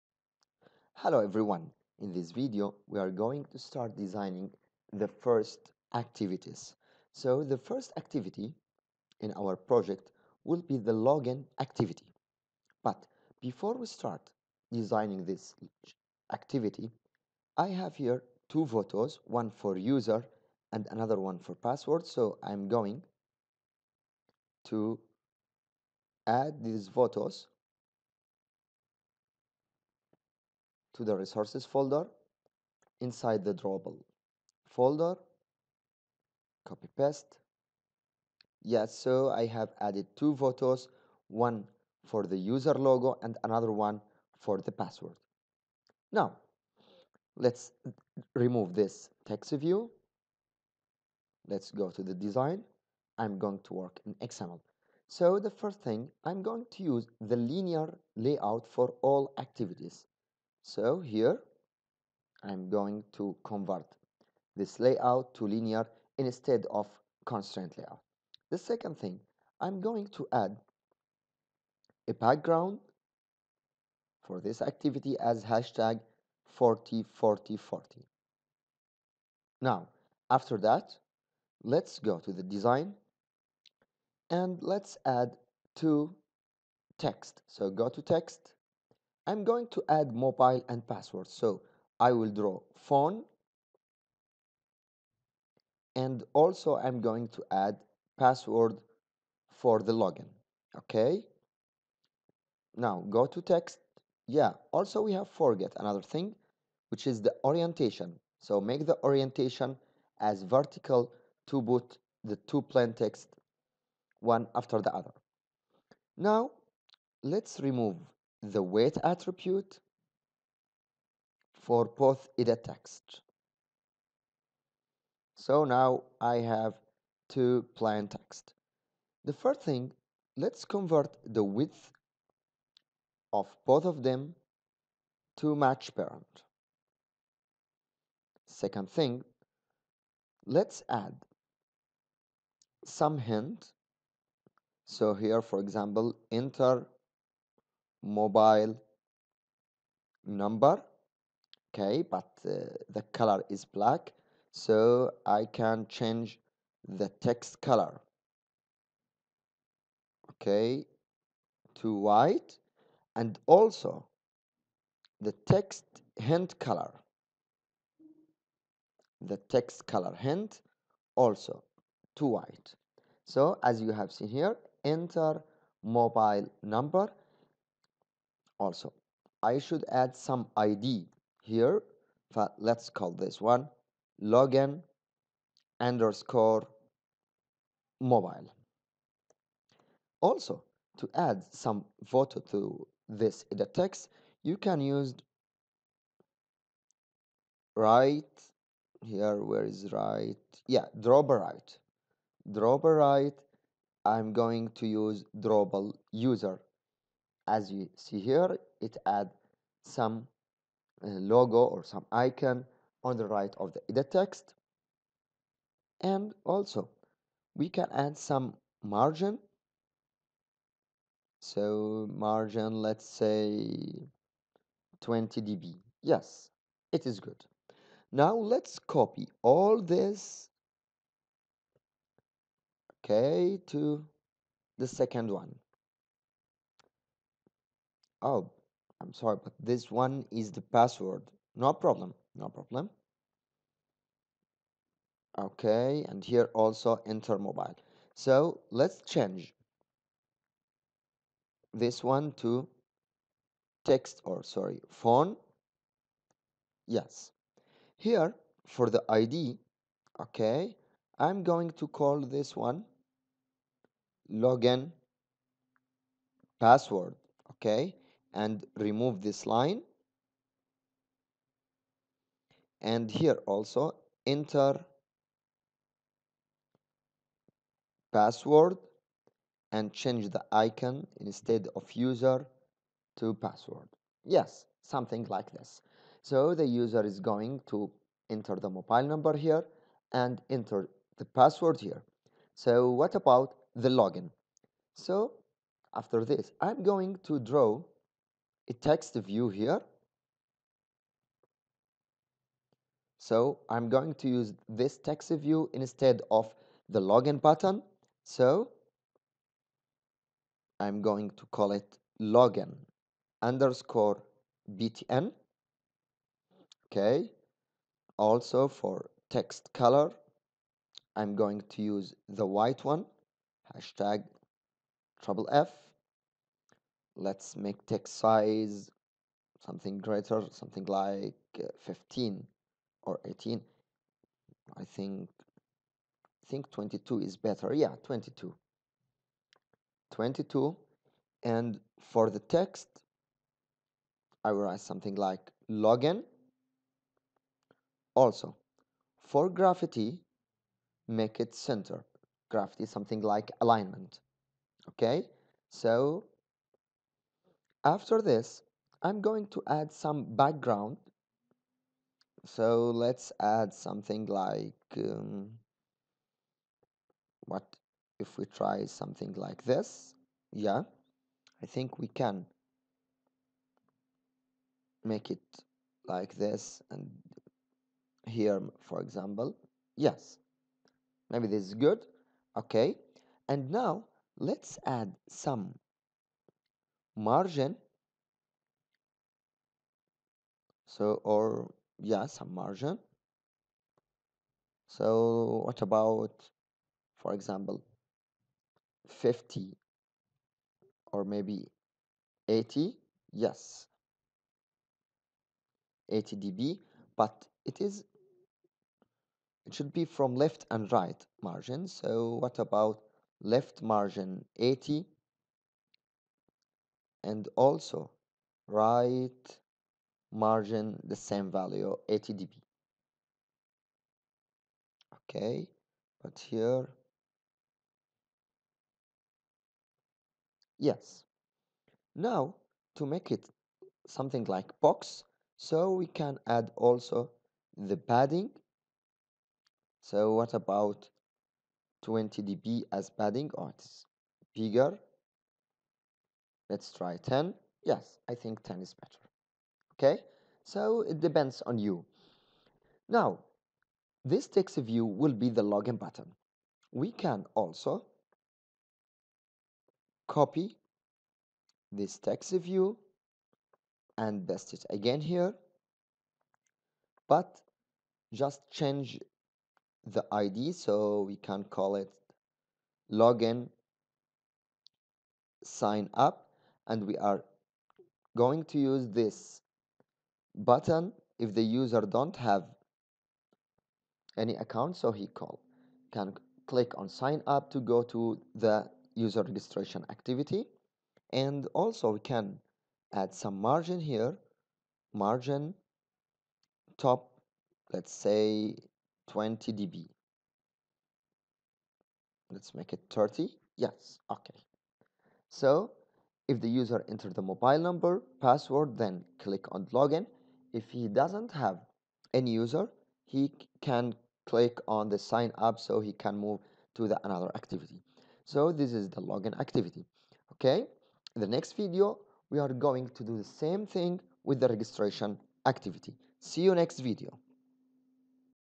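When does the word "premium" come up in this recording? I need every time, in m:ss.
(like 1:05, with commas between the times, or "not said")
not said.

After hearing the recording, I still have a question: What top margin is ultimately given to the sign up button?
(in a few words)
30.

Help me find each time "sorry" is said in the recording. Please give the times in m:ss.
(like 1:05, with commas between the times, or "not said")
3:59, 4:14.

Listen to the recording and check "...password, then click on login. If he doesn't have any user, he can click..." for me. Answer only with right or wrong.
right.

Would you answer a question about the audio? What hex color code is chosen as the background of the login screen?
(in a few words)
#404040.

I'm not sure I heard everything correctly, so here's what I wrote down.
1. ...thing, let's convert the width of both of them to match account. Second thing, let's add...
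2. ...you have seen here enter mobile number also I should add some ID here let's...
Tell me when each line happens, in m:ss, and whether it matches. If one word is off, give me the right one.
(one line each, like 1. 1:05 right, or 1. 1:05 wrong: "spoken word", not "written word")
1. 2:09 wrong: "parent", not "account"
2. 2:53 right.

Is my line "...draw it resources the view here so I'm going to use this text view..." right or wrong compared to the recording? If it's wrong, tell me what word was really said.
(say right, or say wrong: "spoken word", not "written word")
wrong: "takes", not "resources".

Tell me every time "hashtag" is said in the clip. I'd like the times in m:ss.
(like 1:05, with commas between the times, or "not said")
1:15, 5:23.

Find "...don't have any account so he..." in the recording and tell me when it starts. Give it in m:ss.
8:02.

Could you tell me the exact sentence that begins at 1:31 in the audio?
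So I will draw phone and also I'm going to add password for the login.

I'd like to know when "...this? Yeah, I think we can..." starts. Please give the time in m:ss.
6:09.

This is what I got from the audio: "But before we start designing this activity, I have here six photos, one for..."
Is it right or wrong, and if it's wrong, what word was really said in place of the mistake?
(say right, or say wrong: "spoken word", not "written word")
wrong: "two", not "six".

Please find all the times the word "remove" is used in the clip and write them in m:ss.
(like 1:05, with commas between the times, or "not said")
0:48, 1:57, 4:28.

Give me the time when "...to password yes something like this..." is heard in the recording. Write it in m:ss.
4:43.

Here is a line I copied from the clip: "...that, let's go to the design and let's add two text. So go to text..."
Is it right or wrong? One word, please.
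right.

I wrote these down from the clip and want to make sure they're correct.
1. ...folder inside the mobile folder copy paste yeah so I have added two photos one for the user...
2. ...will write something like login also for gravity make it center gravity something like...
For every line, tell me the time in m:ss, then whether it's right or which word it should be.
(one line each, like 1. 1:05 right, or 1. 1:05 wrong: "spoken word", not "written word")
1. 0:31 wrong: "drawable", not "mobile"
2. 5:44 right.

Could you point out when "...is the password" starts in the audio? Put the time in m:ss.
4:00.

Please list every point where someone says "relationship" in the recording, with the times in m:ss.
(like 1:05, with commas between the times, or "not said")
not said.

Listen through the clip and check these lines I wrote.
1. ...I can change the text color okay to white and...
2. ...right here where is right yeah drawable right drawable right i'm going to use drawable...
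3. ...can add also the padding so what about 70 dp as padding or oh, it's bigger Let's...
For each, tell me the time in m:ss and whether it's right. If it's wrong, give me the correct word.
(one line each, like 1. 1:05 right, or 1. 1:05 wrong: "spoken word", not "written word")
1. 2:35 right
2. 3:17 right
3. 7:16 wrong: "20", not "70".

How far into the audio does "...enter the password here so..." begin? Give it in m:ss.
4:50.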